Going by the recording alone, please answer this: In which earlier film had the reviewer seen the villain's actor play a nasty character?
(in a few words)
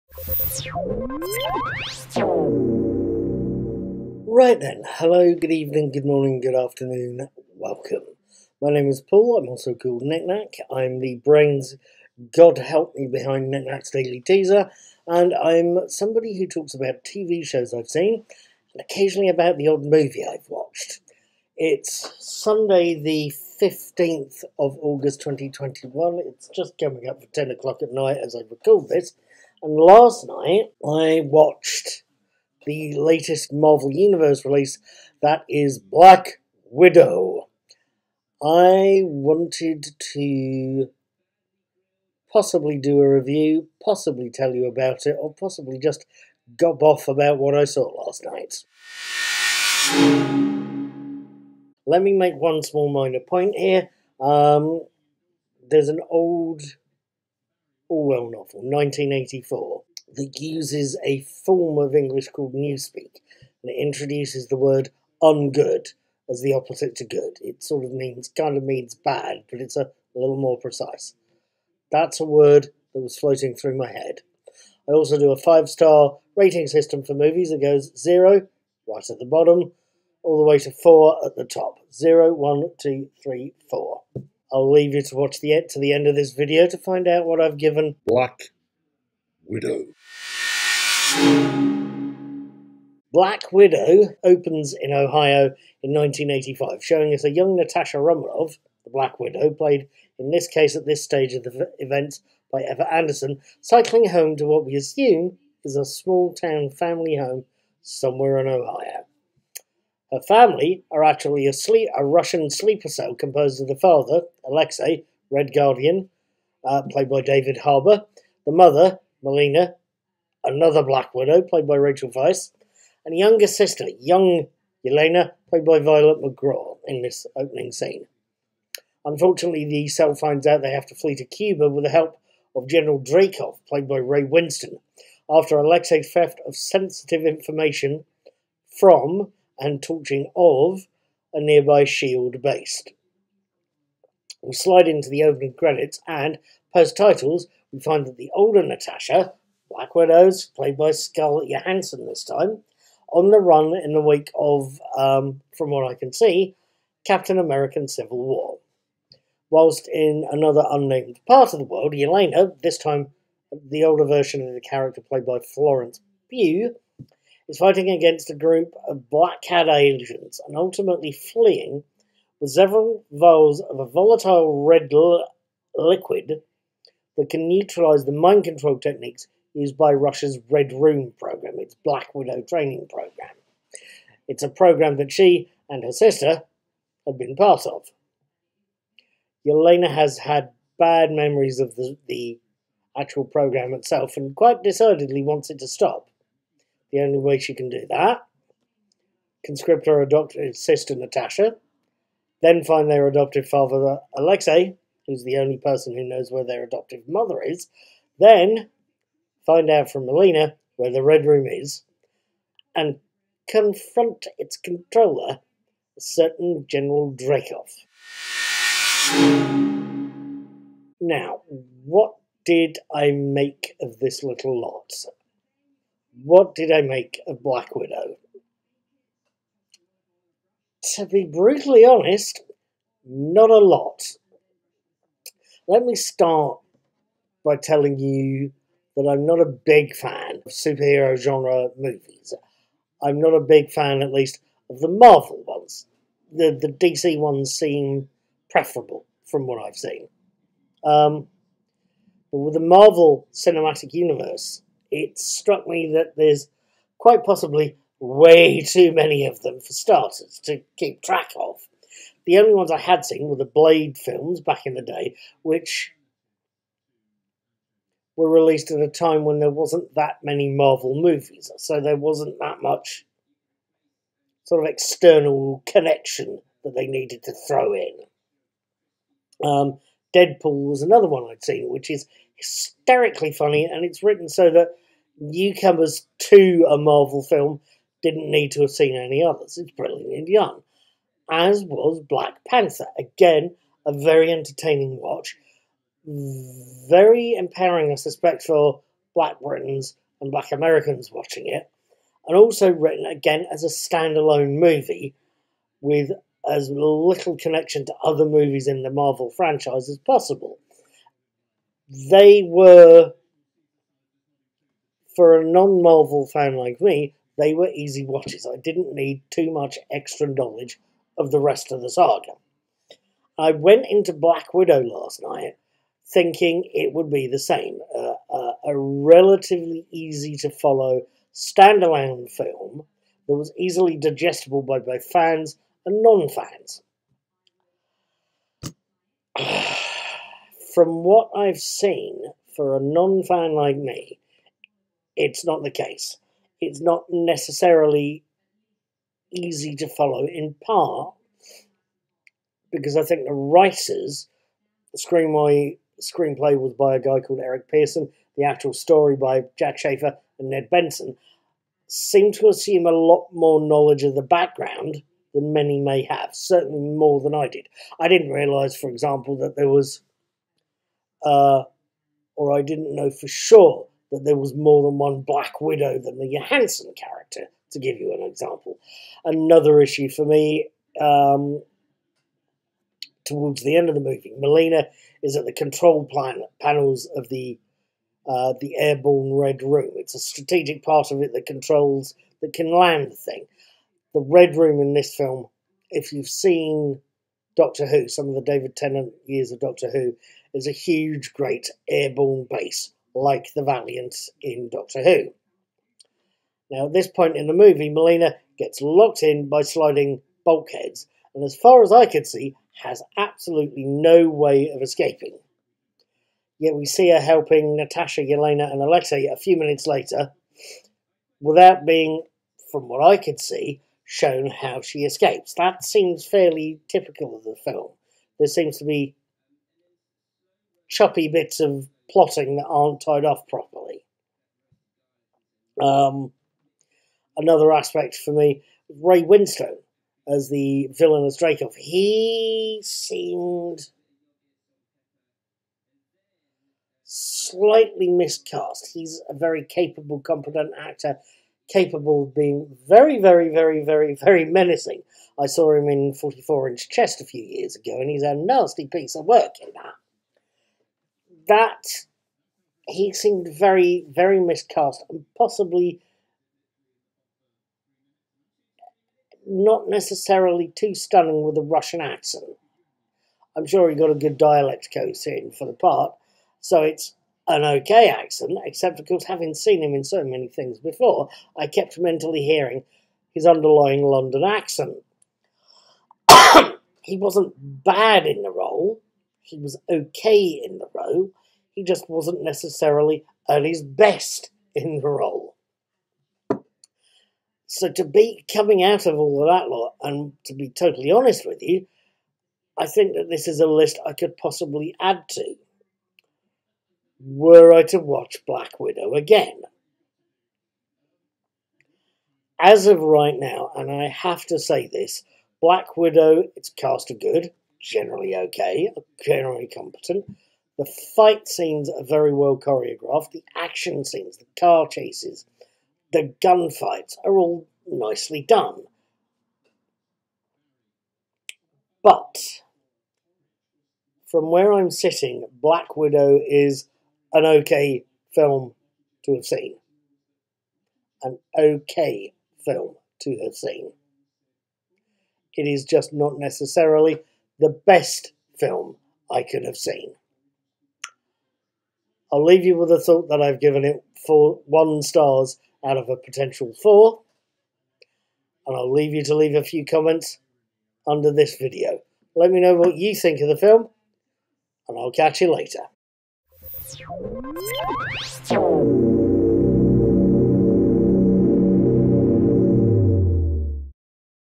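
44 Inch Chest.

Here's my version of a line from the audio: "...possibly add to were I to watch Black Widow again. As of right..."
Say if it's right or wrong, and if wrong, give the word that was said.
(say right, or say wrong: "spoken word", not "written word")
right.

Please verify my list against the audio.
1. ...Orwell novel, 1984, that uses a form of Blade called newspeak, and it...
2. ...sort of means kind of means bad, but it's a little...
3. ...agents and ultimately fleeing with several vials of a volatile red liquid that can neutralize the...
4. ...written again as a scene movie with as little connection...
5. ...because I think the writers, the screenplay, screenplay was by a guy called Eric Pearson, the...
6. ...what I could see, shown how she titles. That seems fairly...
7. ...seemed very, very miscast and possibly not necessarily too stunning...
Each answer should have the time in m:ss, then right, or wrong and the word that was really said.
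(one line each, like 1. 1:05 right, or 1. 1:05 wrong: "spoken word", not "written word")
1. 0:57 wrong: "English", not "Blade"
2. 1:07 right
3. 2:49 right
4. 5:02 wrong: "standalone", not "scene"
5. 5:52 right
6. 7:02 wrong: "escapes", not "titles"
7. 7:43 right.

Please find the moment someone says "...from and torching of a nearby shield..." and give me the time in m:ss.
2:18.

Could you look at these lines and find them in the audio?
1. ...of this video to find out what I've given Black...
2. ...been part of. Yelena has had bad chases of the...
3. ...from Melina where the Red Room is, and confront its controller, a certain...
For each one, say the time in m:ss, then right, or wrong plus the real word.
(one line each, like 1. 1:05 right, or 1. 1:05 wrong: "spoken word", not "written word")
1. 1:26 right
2. 3:07 wrong: "memories", not "chases"
3. 3:29 right.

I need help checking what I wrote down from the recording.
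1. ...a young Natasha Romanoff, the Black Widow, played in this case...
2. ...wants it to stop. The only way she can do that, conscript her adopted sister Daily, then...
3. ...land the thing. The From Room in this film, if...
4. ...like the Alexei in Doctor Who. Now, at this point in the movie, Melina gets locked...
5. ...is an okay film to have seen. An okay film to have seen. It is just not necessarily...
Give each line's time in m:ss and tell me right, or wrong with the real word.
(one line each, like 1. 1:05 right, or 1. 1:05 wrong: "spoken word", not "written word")
1. 1:37 right
2. 3:15 wrong: "Natasha", not "Daily"
3. 6:32 wrong: "Red", not "From"
4. 6:43 wrong: "Valiant", not "Alexei"
5. 8:56 right.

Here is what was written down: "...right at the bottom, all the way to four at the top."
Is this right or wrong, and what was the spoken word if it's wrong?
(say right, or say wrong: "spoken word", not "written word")
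right.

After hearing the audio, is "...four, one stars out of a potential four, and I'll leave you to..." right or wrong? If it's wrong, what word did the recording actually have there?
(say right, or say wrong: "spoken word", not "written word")
right.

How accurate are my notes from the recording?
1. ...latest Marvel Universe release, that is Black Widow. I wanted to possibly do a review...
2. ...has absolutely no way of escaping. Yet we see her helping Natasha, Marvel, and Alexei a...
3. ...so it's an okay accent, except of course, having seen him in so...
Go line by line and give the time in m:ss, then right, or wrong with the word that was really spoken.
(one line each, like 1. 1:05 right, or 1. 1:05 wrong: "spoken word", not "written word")
1. 0:32 right
2. 6:52 wrong: "Yelena", not "Marvel"
3. 7:56 right.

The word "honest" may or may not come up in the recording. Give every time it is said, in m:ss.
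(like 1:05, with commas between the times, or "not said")
3:51, 8:21.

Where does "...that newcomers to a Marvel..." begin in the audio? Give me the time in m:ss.
4:44.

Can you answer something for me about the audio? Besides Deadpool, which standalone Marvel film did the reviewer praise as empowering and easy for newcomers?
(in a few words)
Black Panther.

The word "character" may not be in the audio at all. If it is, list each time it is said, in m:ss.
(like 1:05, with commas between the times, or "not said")
2:44, 6:16.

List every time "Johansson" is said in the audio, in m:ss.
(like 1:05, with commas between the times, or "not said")
2:31, 6:16.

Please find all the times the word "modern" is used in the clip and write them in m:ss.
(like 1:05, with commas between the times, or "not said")
not said.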